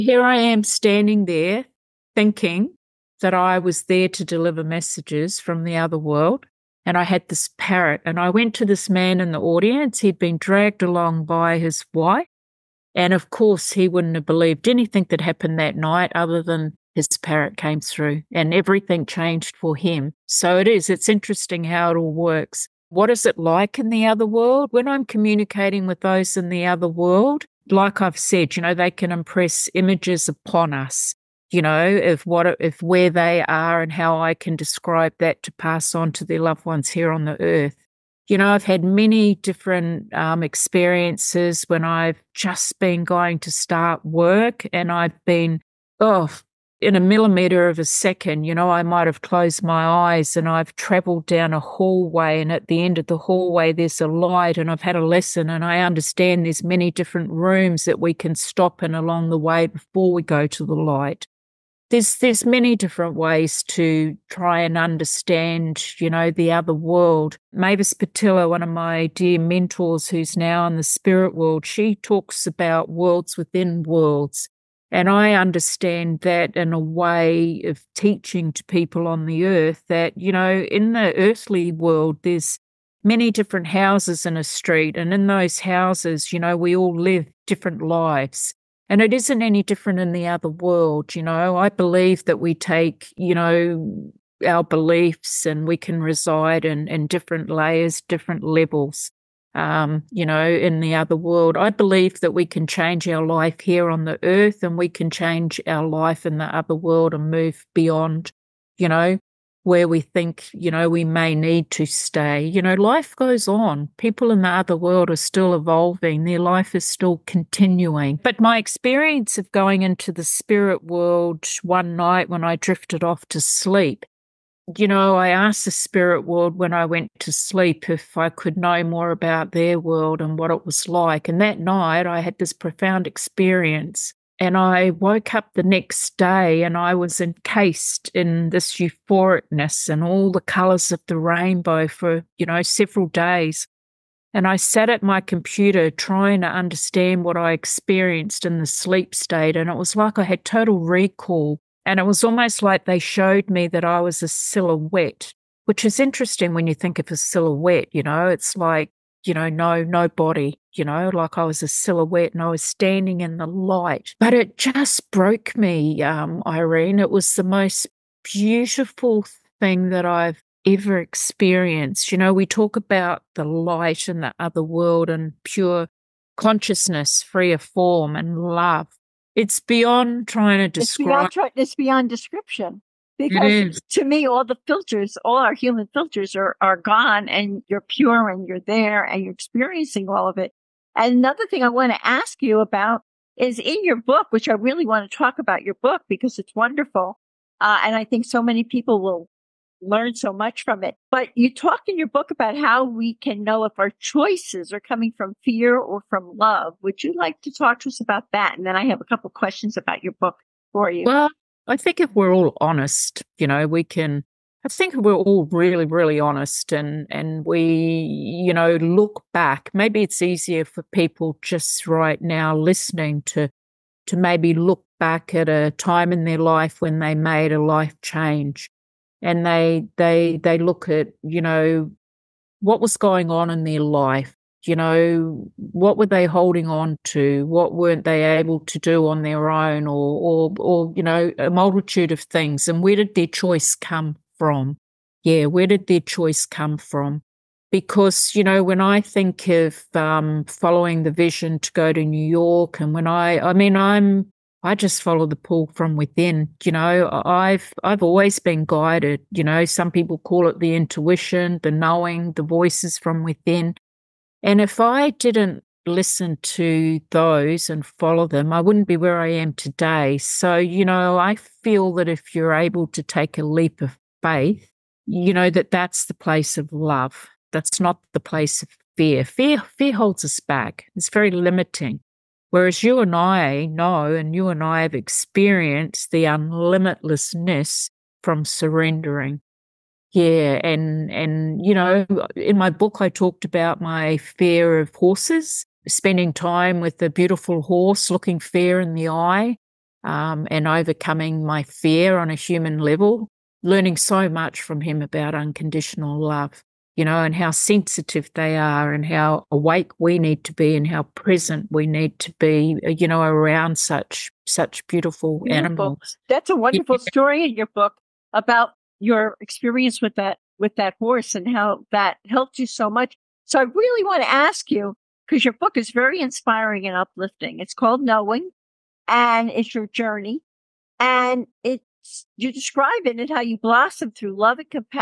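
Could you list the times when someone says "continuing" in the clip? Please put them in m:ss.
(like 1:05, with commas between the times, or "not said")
1:57.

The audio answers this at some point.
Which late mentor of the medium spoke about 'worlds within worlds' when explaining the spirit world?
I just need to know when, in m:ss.
1:07.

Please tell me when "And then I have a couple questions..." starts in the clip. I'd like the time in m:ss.
3:28.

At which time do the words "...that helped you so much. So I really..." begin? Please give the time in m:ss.
5:21.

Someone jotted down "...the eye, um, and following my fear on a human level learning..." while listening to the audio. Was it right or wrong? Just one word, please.
wrong.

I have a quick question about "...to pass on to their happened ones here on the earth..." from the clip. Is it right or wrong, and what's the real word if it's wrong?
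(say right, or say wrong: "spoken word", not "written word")
wrong: "loved", not "happened".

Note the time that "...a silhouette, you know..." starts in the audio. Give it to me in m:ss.
2:37.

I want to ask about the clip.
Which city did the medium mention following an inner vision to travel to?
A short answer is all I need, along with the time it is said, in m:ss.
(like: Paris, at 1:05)
New York, at 4:12.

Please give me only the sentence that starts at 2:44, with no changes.
But it just broke me, um, Irene.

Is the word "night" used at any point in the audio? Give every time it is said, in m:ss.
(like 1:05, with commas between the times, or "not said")
0:15, 2:01, 2:11.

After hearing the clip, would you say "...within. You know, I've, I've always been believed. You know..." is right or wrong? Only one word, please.
wrong.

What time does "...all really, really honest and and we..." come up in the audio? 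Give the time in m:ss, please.
3:35.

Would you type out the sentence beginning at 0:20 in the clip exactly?
So it is, it's interesting how it all works.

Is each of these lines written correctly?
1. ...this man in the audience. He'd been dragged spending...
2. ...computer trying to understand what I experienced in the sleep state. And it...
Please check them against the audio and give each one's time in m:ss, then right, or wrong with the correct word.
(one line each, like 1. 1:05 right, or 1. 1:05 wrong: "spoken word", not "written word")
1. 0:08 wrong: "along", not "spending"
2. 2:25 right.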